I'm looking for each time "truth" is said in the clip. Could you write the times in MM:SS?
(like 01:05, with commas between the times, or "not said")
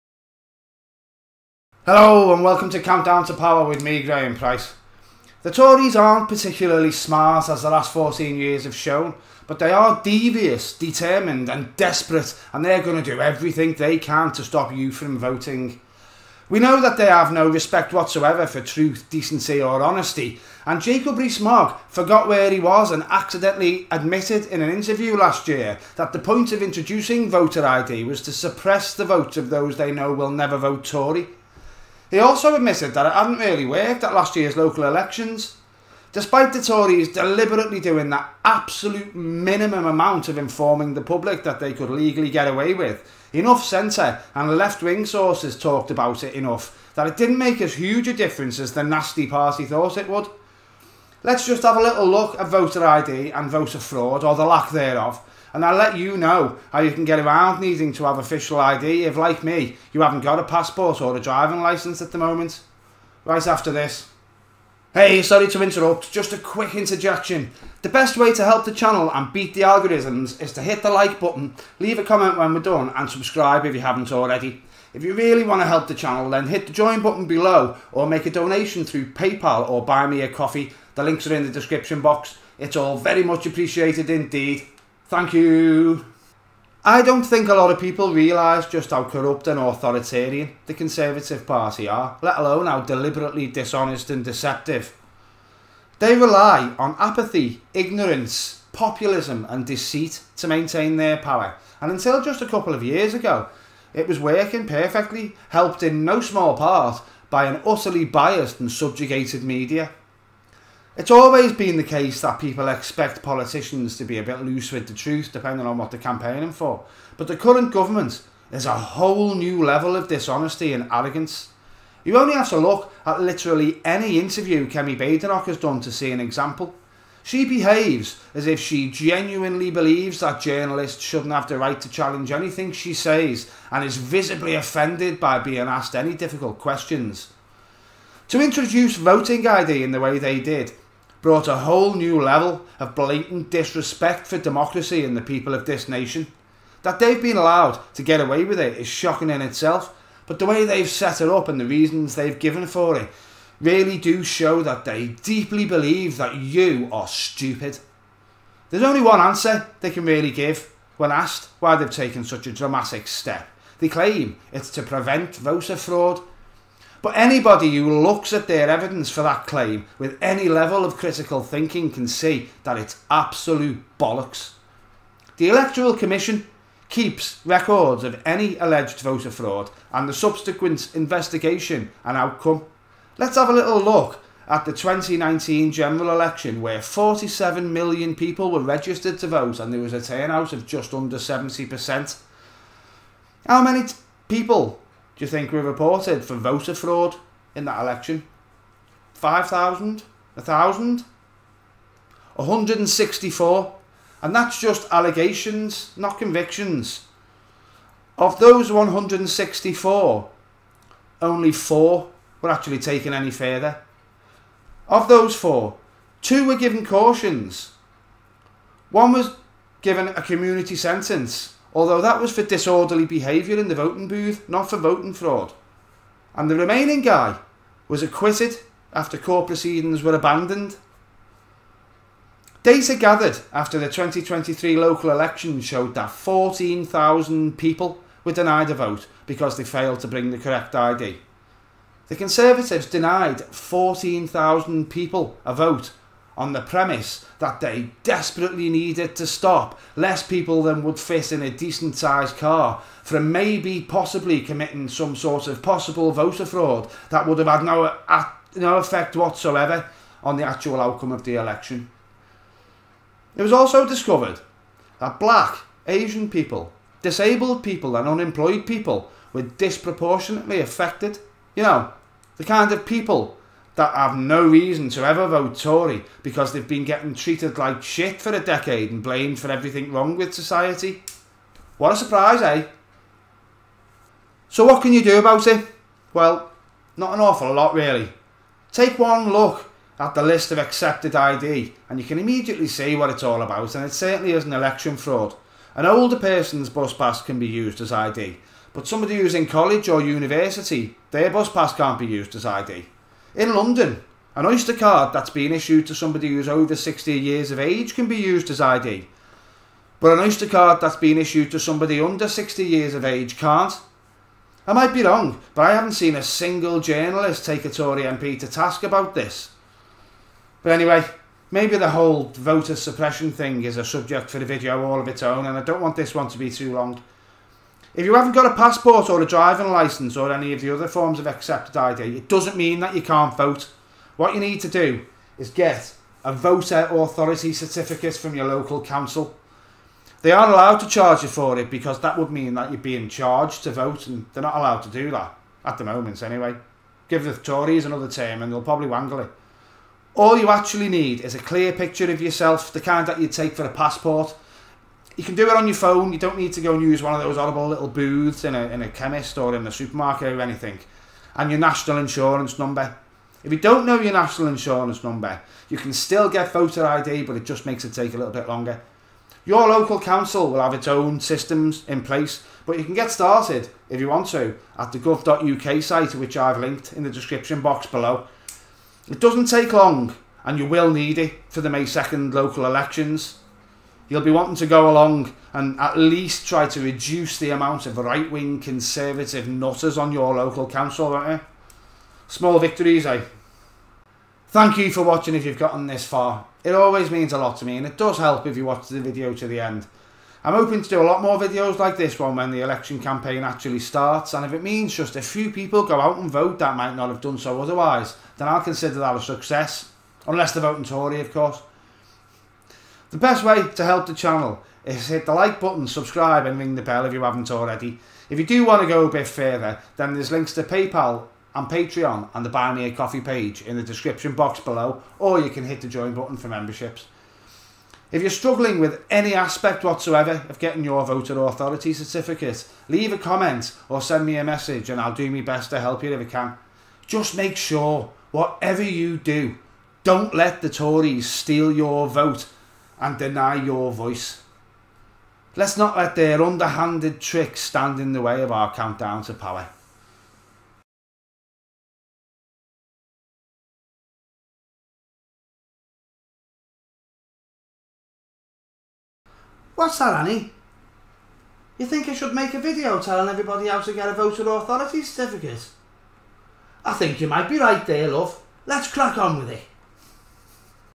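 00:18, 01:54.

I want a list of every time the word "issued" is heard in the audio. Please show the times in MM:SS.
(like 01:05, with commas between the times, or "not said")
05:05, 05:11.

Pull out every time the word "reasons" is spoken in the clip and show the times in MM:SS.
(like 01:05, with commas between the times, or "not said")
02:31, 04:34.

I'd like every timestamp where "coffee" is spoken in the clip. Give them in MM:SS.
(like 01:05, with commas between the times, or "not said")
01:20, 07:02.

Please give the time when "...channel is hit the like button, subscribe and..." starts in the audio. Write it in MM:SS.
06:54.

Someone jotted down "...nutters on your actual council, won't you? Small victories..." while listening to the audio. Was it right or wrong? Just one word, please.
wrong.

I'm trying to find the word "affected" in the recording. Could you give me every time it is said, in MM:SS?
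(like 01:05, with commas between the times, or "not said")
04:30.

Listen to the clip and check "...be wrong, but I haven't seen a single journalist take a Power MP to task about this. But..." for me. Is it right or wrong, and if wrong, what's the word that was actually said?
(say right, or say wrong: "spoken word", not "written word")
wrong: "Tory", not "Power".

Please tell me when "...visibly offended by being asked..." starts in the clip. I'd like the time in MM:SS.
02:13.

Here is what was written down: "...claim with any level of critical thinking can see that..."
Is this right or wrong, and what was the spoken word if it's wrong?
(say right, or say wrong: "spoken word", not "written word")
right.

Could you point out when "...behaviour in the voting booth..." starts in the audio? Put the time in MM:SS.
03:43.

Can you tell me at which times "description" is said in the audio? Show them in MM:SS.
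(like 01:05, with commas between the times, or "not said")
01:21, 06:17, 07:03.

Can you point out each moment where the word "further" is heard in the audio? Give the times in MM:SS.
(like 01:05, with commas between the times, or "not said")
03:33, 06:59.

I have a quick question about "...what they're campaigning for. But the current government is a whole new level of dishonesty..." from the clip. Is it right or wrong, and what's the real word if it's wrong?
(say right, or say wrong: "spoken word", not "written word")
right.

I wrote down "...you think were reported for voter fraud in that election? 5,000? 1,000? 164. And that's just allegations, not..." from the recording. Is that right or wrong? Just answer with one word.
right.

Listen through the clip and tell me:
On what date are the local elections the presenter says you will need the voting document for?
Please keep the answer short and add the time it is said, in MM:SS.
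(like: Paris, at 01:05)
May 2nd, at 06:21.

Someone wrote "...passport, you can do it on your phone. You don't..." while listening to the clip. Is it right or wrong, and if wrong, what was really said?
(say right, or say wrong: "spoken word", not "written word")
right.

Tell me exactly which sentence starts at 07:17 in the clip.
Just make sure, whatever you do, don't let the Tories steal your vote and deny your voice.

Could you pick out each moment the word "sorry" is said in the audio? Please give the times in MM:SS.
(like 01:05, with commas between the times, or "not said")
01:05.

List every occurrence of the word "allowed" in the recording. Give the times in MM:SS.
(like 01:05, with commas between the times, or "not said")
02:27, 05:40, 05:44.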